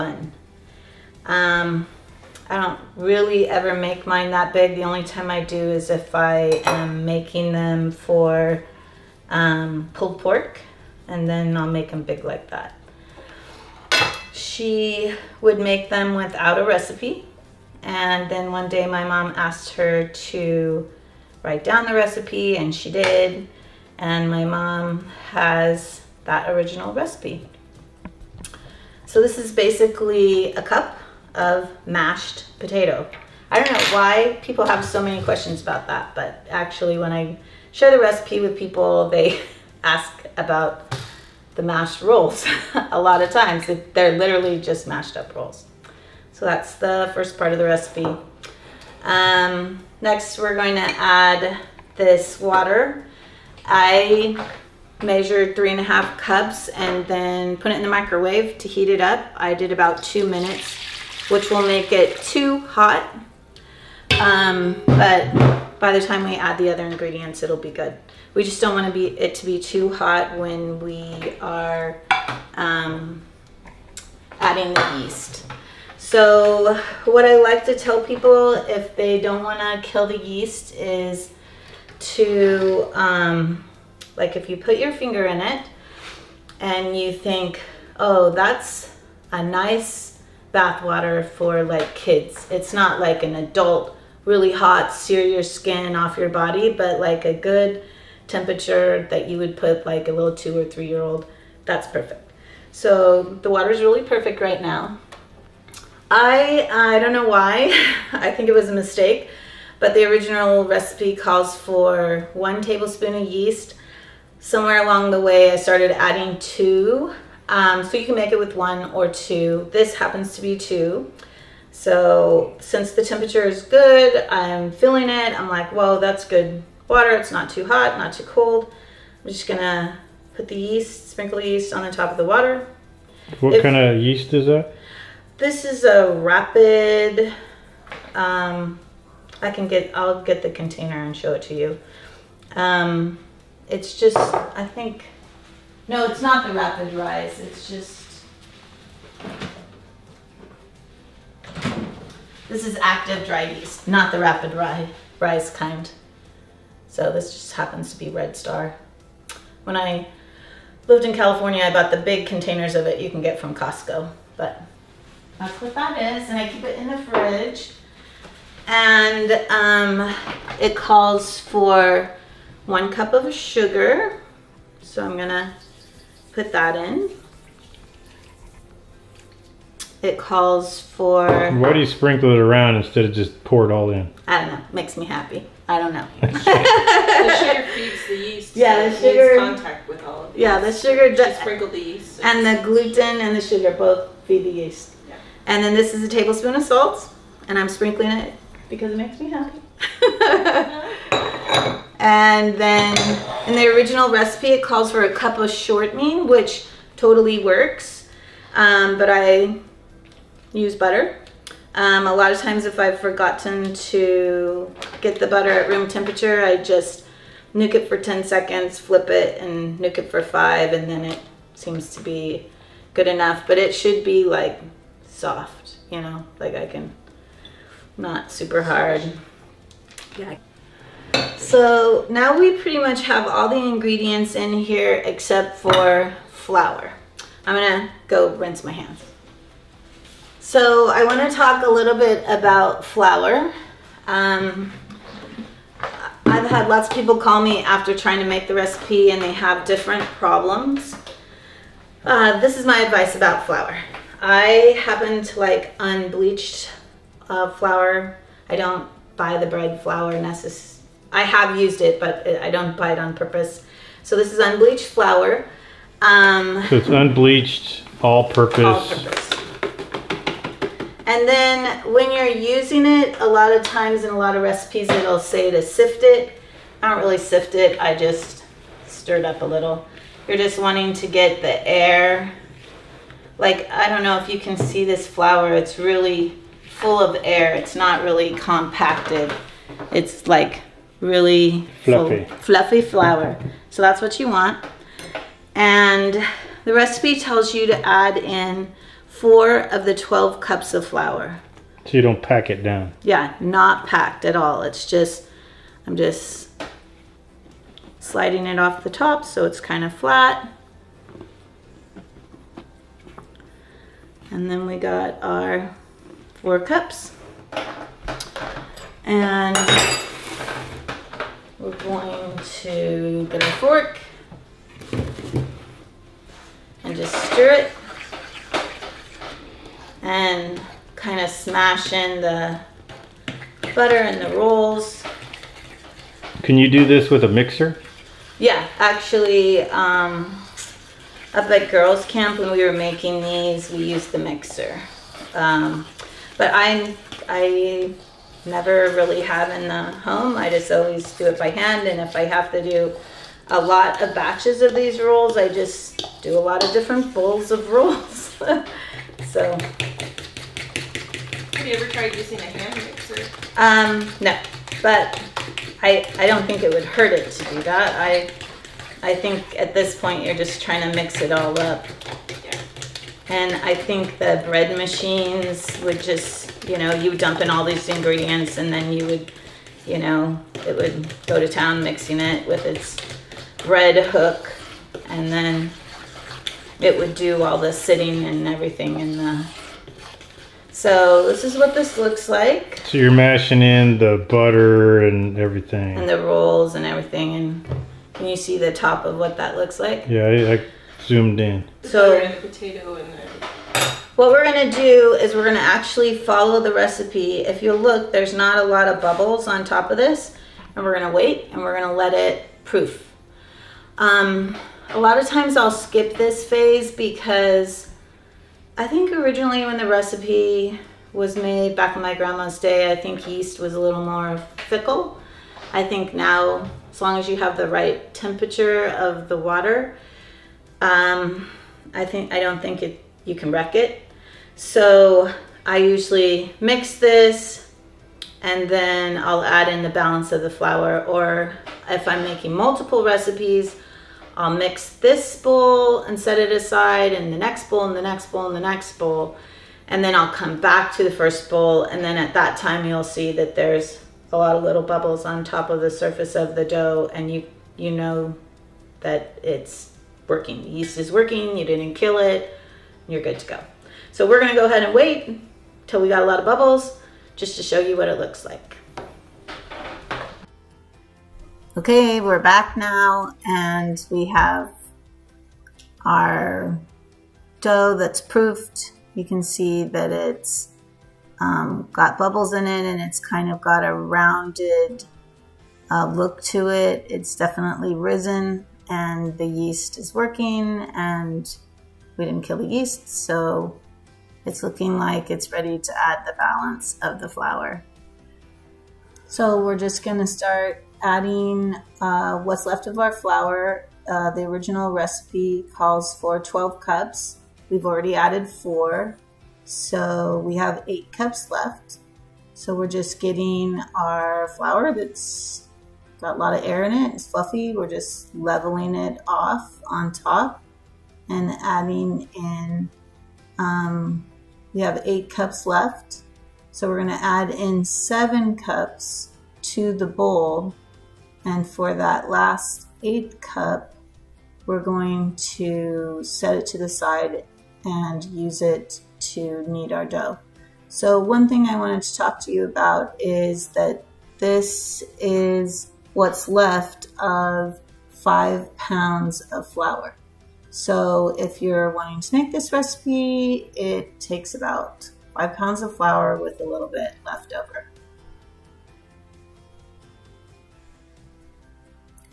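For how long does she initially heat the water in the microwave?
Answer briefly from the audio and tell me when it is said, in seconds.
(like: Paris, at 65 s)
2 minutes, at 60 s.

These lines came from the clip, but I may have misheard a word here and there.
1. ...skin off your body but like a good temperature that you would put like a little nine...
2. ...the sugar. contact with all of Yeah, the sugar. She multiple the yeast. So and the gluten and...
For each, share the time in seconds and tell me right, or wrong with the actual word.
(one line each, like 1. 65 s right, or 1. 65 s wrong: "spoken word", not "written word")
1. 95 s wrong: "two", not "nine"
2. 188 s wrong: "sprinkle", not "multiple".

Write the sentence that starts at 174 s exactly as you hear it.
So I'm gonna put that in it calls for.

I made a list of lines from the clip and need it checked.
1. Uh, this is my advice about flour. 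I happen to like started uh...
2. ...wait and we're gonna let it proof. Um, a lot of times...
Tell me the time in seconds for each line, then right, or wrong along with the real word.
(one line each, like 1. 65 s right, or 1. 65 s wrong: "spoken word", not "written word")
1. 252 s wrong: "unbleached", not "started"
2. 411 s right.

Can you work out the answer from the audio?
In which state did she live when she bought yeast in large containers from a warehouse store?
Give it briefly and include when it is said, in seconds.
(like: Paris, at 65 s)
California, at 161 s.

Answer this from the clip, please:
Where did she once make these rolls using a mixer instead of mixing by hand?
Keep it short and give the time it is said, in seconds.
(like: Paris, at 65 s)
girls camp, at 341 s.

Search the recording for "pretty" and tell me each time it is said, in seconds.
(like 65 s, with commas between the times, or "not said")
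232 s.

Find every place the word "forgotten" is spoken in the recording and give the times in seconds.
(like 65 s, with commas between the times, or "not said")
212 s.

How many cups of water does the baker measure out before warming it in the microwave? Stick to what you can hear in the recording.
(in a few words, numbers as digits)
3.5 cups.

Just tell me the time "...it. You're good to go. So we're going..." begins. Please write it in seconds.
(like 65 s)
462 s.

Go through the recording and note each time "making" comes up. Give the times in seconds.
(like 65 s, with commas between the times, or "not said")
7 s, 342 s, 442 s.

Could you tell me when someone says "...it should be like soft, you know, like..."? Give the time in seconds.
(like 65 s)
223 s.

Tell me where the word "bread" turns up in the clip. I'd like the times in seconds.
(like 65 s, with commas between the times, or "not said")
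259 s, 374 s, 383 s.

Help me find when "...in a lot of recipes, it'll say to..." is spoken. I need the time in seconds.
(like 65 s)
274 s.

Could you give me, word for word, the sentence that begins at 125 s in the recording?
I'm like, well, that's good water.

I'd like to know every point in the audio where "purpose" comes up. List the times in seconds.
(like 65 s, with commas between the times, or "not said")
263 s, 268 s.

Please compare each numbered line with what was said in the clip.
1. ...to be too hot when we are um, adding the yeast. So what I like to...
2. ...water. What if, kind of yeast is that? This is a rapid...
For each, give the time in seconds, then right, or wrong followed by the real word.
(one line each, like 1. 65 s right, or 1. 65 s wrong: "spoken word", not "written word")
1. 69 s right
2. 132 s right.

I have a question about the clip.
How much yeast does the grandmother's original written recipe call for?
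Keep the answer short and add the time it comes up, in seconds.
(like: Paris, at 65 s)
1 tablespoon, at 112 s.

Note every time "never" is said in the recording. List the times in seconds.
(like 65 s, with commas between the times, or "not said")
348 s.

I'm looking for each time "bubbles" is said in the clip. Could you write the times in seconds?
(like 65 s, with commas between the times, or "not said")
409 s, 454 s, 466 s, 482 s.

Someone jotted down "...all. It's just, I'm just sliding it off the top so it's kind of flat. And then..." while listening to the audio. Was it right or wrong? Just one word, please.
right.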